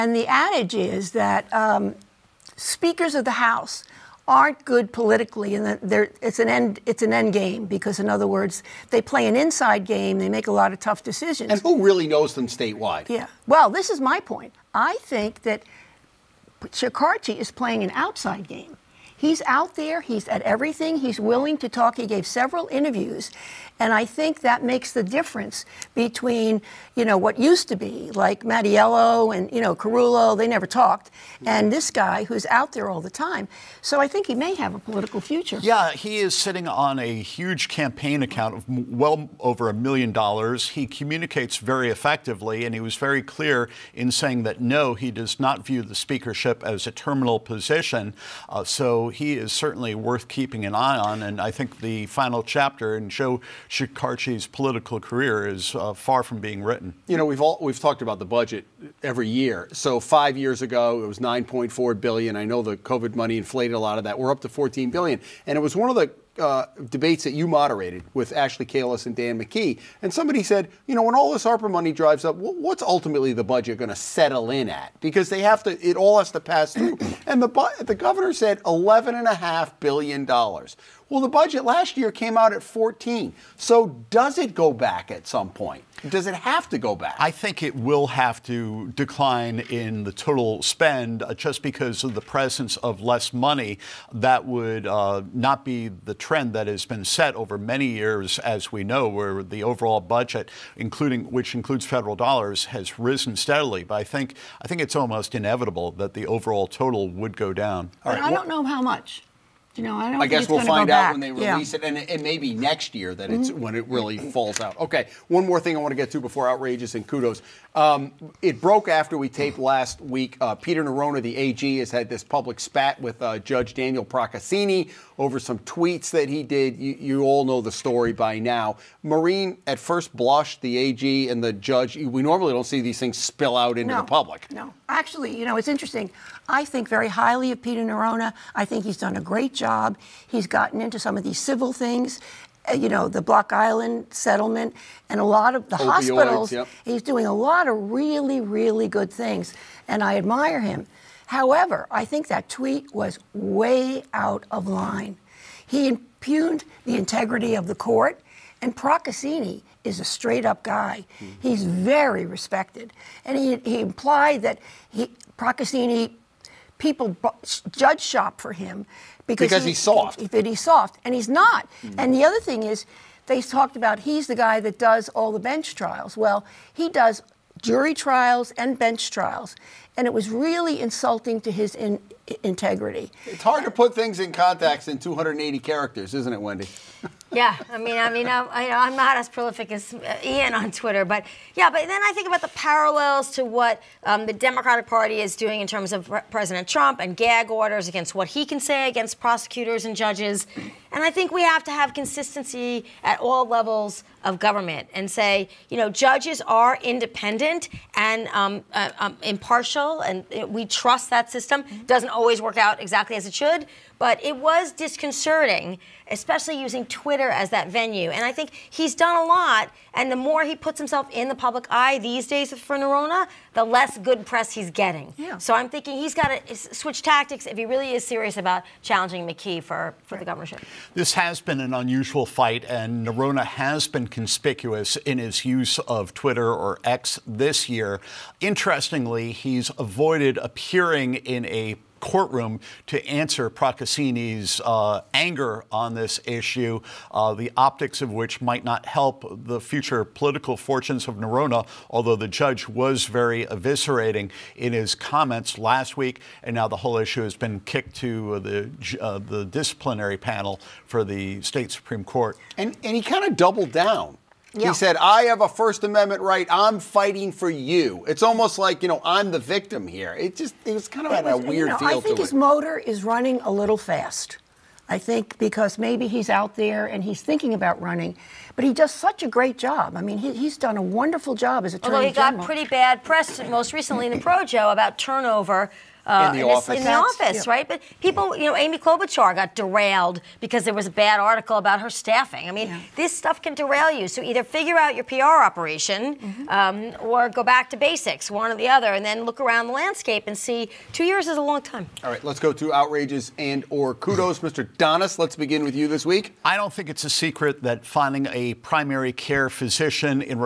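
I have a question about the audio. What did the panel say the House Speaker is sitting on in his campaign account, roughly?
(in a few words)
over a million dollars.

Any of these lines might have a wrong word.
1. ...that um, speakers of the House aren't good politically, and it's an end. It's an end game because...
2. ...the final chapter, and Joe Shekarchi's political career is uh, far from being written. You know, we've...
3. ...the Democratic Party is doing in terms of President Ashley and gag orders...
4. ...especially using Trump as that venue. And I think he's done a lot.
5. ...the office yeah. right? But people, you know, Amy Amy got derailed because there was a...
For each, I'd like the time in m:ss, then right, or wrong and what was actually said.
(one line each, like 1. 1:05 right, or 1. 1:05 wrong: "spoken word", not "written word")
1. 0:01 right
2. 0:51 right
3. 3:14 wrong: "Trump", not "Ashley"
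4. 3:36 wrong: "Twitter", not "Trump"
5. 4:46 wrong: "Klobuchar", not "Amy".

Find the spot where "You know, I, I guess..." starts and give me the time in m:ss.
1:49.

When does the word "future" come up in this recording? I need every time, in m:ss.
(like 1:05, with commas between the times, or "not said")
0:35, 4:09.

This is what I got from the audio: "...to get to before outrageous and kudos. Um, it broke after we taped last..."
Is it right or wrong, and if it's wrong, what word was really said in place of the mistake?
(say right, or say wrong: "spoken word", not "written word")
right.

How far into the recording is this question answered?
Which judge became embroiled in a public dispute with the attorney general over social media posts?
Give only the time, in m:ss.
2:03.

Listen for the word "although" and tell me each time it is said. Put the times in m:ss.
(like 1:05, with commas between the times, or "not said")
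4:11, 4:41.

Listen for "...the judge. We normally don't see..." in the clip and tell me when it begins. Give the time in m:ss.
2:11.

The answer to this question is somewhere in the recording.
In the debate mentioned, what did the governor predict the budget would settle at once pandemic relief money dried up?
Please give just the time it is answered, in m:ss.
1:18.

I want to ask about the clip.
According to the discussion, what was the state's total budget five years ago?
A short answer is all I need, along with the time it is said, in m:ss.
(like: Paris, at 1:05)
9.4 billion, at 1:01.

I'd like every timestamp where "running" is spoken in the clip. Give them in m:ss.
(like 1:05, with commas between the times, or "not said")
4:33, 4:37.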